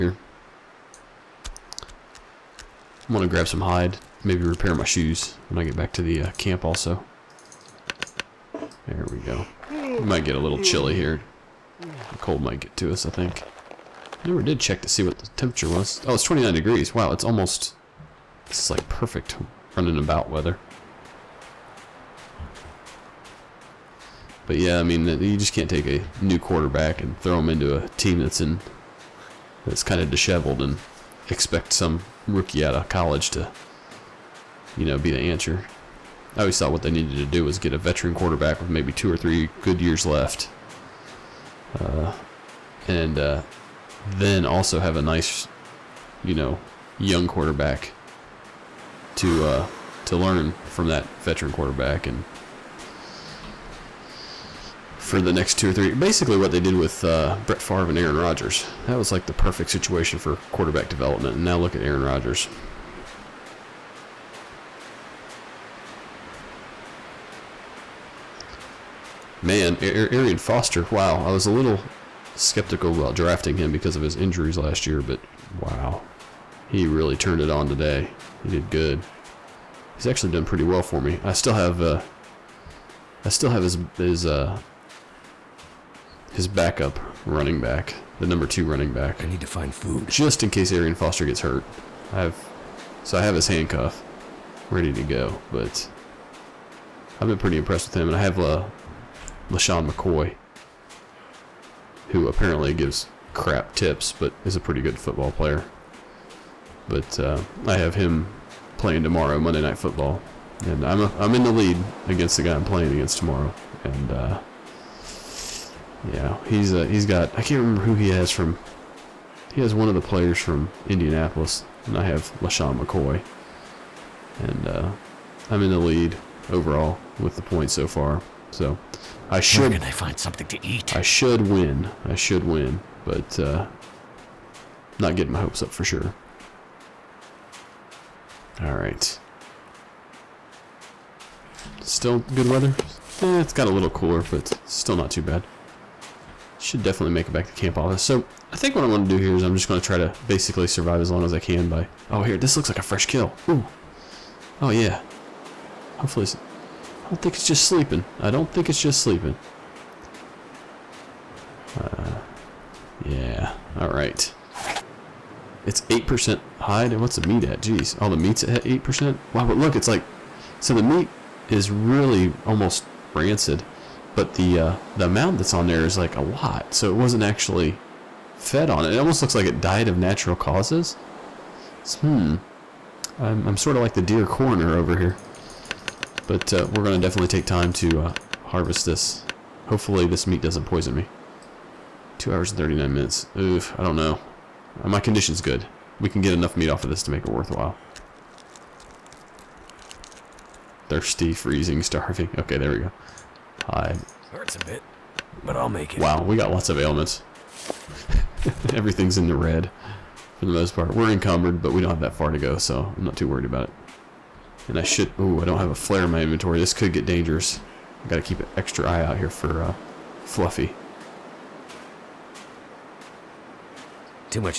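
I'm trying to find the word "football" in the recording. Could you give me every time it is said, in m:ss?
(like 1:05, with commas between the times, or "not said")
1:44, 1:49.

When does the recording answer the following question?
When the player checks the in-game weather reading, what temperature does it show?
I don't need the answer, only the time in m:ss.
0:16.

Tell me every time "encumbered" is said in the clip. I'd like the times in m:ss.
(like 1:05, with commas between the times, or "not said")
3:31.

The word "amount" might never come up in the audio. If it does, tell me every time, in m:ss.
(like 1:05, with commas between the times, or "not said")
2:55.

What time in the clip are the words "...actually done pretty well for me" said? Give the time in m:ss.
1:20.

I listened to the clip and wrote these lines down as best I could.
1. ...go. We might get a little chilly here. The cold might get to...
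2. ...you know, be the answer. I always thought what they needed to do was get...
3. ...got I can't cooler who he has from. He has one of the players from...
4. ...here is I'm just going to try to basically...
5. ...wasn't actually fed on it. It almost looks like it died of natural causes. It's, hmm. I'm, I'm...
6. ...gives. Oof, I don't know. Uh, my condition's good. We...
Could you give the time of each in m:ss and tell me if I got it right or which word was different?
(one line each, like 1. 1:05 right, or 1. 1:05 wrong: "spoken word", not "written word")
1. 0:09 right
2. 0:34 right
3. 1:57 wrong: "remember", not "cooler"
4. 2:29 right
5. 2:56 right
6. 3:12 wrong: "minutes", not "gives".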